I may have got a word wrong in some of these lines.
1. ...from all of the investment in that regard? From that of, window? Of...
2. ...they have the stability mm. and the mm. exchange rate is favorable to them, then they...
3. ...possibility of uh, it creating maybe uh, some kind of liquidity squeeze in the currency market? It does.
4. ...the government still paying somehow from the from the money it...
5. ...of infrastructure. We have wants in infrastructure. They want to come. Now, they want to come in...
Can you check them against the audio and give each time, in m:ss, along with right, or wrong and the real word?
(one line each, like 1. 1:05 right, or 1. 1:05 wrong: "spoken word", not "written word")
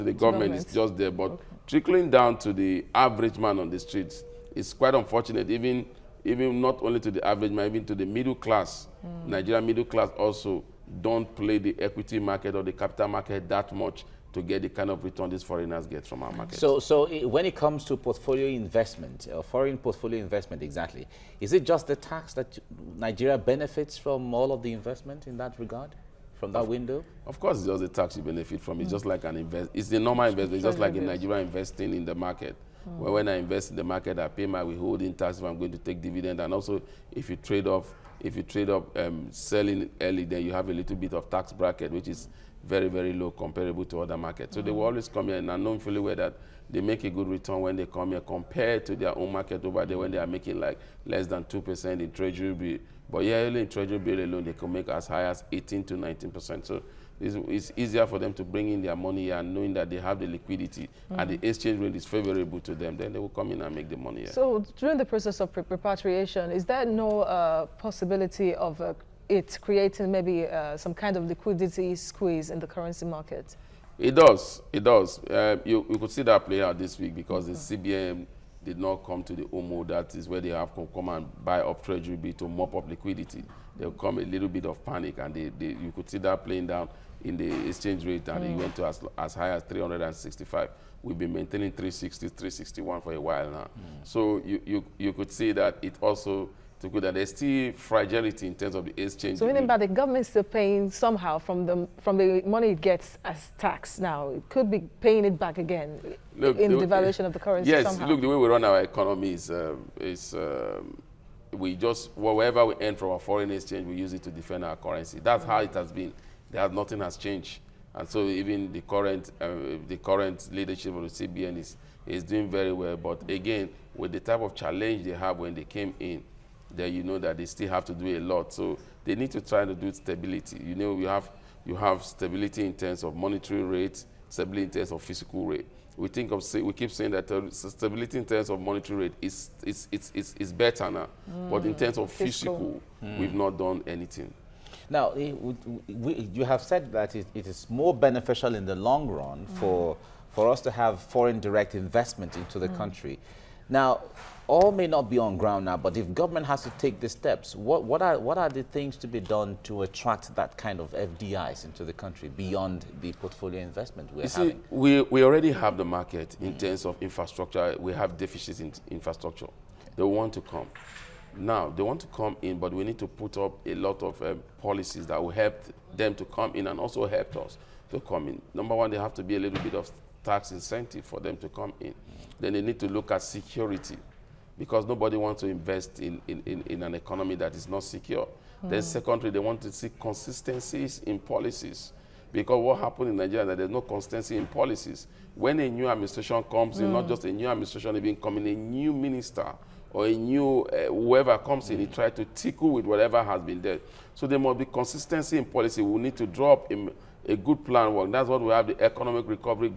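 1. 0:23 right
2. 0:59 wrong: "liquidity", not "stability"
3. 1:07 right
4. 1:39 right
5. 2:46 wrong: "deficits", not "wants".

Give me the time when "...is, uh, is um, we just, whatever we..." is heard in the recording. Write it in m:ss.
1:49.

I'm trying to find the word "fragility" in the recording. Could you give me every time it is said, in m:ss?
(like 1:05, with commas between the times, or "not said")
1:37.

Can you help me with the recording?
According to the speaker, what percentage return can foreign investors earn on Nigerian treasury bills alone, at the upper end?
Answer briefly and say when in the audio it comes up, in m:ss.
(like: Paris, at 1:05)
19%, at 0:55.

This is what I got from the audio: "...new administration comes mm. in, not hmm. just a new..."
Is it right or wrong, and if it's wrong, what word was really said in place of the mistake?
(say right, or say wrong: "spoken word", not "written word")
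right.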